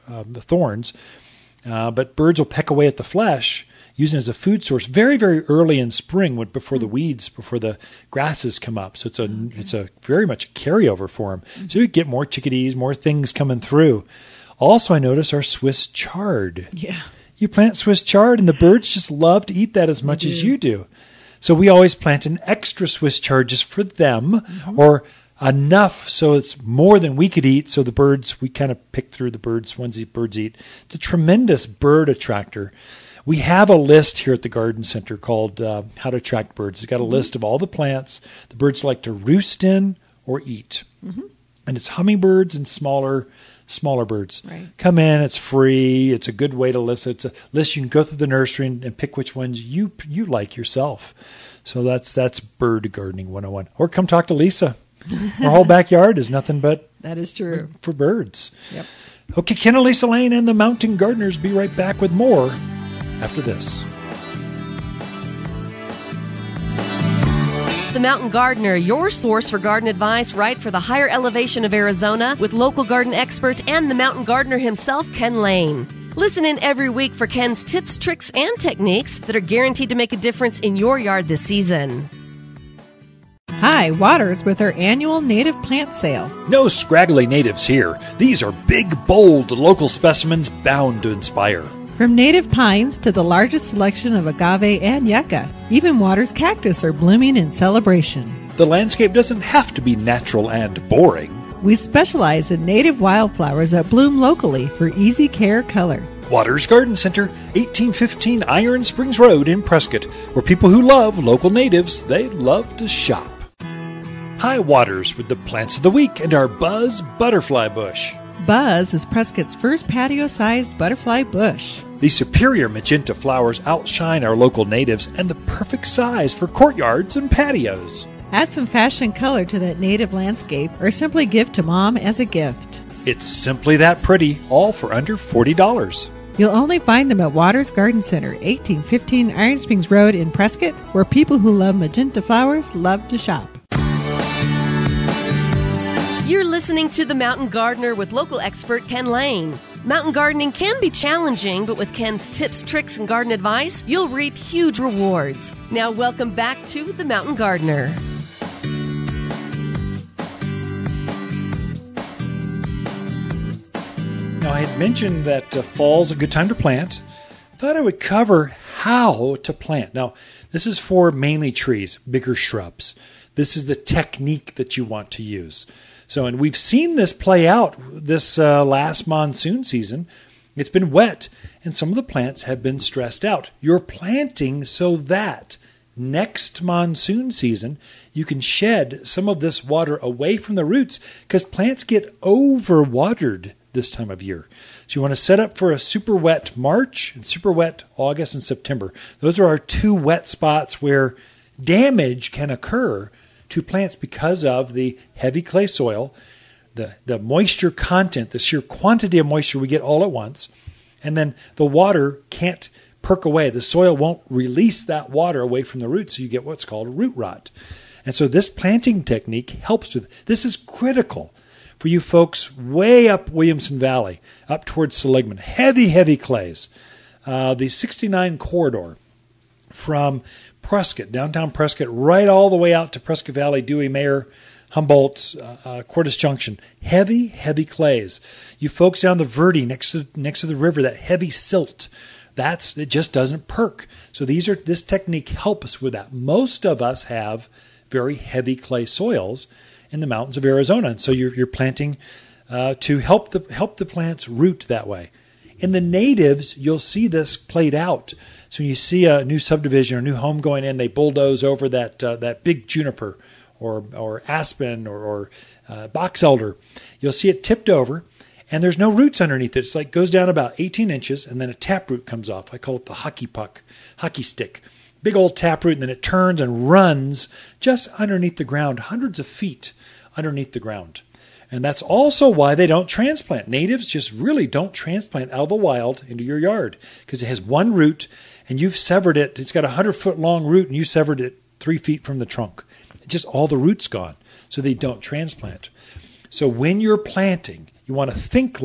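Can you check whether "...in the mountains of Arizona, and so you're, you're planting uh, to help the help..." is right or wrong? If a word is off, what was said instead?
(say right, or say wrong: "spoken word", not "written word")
right.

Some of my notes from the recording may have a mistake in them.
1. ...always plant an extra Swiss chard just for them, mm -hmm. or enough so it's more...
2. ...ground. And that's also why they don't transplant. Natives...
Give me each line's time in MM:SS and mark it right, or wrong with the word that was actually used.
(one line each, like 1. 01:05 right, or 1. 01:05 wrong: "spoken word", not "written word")
1. 00:21 right
2. 04:40 right.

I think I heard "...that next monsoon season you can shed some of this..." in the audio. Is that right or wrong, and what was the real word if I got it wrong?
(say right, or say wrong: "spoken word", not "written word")
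right.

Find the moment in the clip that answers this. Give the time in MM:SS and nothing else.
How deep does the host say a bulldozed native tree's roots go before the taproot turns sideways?
04:30.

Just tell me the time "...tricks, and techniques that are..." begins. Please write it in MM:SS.
01:17.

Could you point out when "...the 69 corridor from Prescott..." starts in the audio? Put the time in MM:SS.
03:47.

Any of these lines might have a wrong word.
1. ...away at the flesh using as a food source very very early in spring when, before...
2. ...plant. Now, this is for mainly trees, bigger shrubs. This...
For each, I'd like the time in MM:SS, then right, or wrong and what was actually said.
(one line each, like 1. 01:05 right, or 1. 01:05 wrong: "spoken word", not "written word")
1. 00:02 right
2. 02:49 right.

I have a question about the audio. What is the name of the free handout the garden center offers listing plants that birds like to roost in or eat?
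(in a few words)
How to Attract Birds.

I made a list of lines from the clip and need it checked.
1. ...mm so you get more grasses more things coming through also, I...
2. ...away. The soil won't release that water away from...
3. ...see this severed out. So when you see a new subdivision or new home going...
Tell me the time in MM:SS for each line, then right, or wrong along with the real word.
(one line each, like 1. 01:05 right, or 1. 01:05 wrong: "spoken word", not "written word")
1. 00:11 wrong: "chickadees", not "grasses"
2. 03:33 right
3. 04:16 wrong: "played", not "severed".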